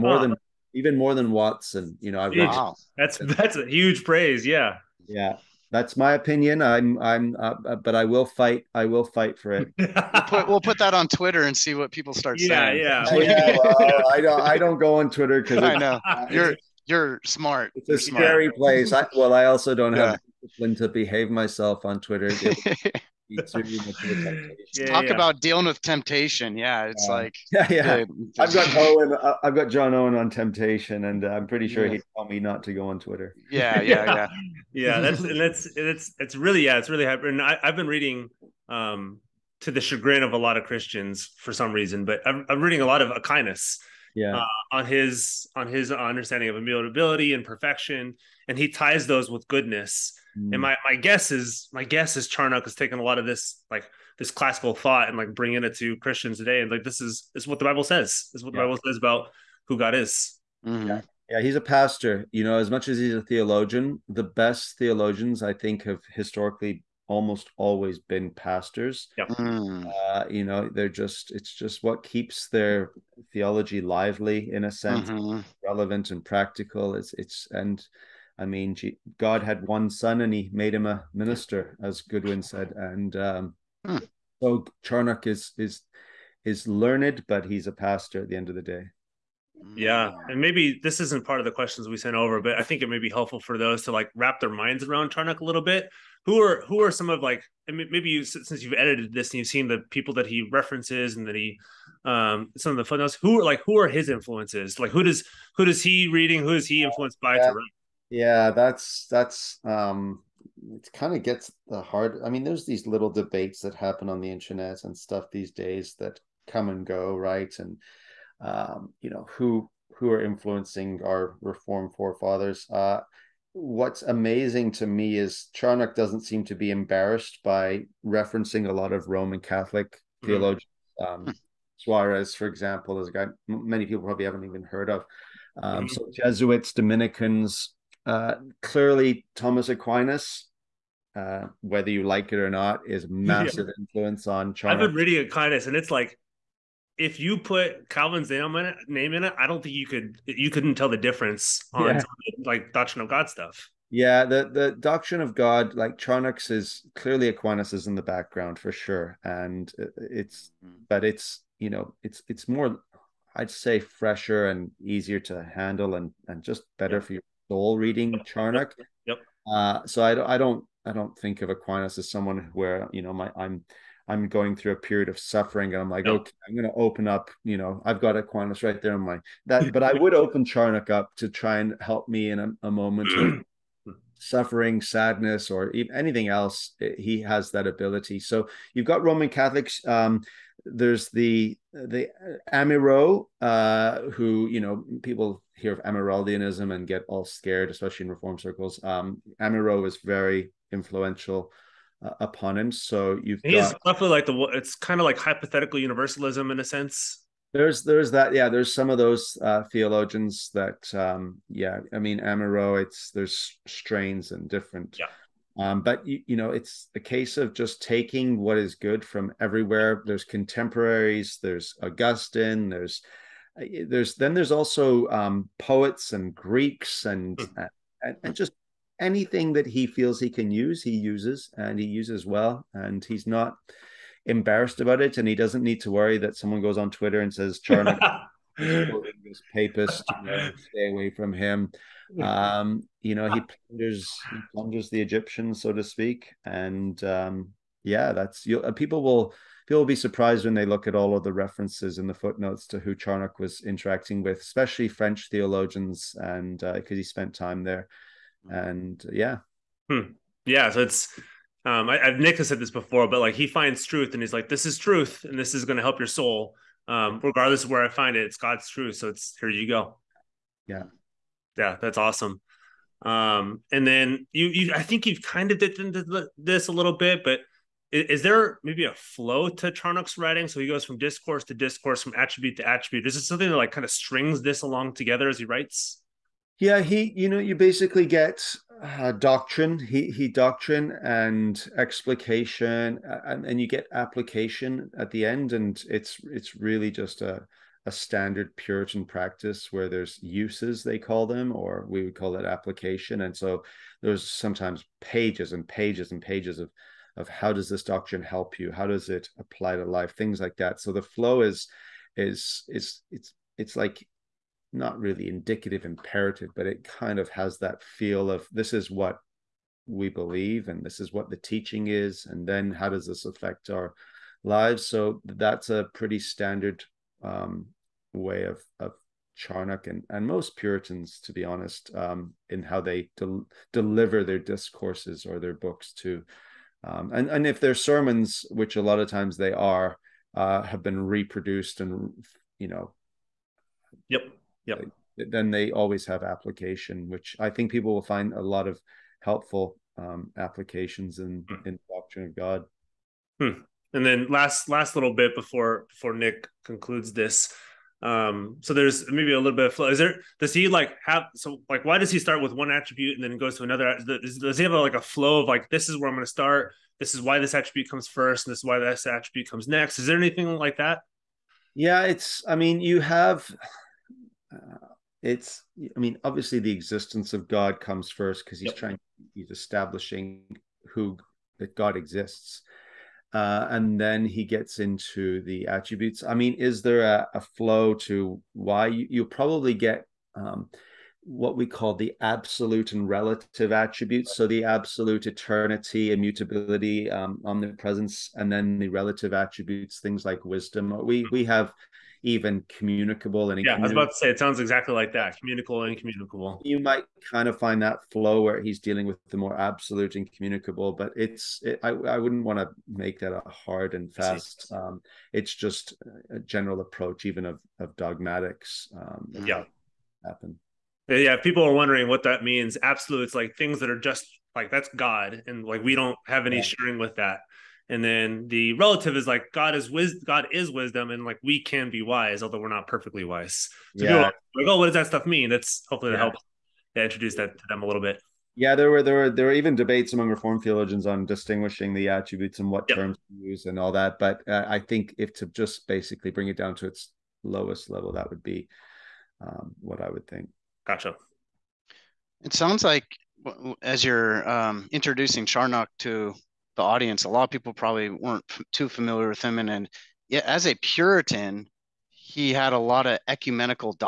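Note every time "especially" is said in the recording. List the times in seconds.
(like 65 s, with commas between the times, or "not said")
197 s, 254 s.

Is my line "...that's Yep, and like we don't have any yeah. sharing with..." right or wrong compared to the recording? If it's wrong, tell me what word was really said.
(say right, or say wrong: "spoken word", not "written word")
wrong: "God", not "Yep".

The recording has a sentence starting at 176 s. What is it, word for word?
okay, I'm going to open up.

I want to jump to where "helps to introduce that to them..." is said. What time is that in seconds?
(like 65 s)
436 s.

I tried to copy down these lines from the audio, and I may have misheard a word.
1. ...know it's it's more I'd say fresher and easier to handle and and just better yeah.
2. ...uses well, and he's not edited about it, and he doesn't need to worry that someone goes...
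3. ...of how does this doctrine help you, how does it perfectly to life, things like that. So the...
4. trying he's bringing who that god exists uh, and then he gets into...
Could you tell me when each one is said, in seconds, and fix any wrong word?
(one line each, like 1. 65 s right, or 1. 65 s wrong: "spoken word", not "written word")
1. 161 s right
2. 231 s wrong: "embarrassed", not "edited"
3. 307 s wrong: "apply", not "perfectly"
4. 378 s wrong: "establishing", not "bringing".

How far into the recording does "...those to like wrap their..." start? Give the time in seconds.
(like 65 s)
93 s.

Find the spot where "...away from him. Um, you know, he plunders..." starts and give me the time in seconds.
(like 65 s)
240 s.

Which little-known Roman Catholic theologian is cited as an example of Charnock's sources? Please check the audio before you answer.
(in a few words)
Suarez.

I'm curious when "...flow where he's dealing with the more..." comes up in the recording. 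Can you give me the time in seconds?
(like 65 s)
408 s.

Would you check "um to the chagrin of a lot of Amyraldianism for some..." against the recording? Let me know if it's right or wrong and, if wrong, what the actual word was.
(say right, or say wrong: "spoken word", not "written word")
wrong: "Christians", not "Amyraldianism".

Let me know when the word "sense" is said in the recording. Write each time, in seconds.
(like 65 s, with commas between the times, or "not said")
74 s, 206 s.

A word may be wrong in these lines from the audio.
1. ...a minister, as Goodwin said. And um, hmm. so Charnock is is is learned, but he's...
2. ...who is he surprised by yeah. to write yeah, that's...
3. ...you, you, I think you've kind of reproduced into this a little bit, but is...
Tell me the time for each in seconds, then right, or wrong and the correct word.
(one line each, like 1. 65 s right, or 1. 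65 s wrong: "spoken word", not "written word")
1. 80 s right
2. 106 s wrong: "influenced", not "surprised"
3. 274 s wrong: "dipped", not "reproduced".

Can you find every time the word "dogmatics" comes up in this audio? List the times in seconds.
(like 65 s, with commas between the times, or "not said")
417 s.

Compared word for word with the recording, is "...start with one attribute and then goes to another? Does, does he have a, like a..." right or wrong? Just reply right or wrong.
right.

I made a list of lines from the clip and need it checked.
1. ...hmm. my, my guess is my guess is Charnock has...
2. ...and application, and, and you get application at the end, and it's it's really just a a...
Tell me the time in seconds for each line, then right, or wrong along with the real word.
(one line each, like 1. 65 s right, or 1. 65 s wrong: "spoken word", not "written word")
1. 50 s right
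2. 291 s wrong: "explication", not "application".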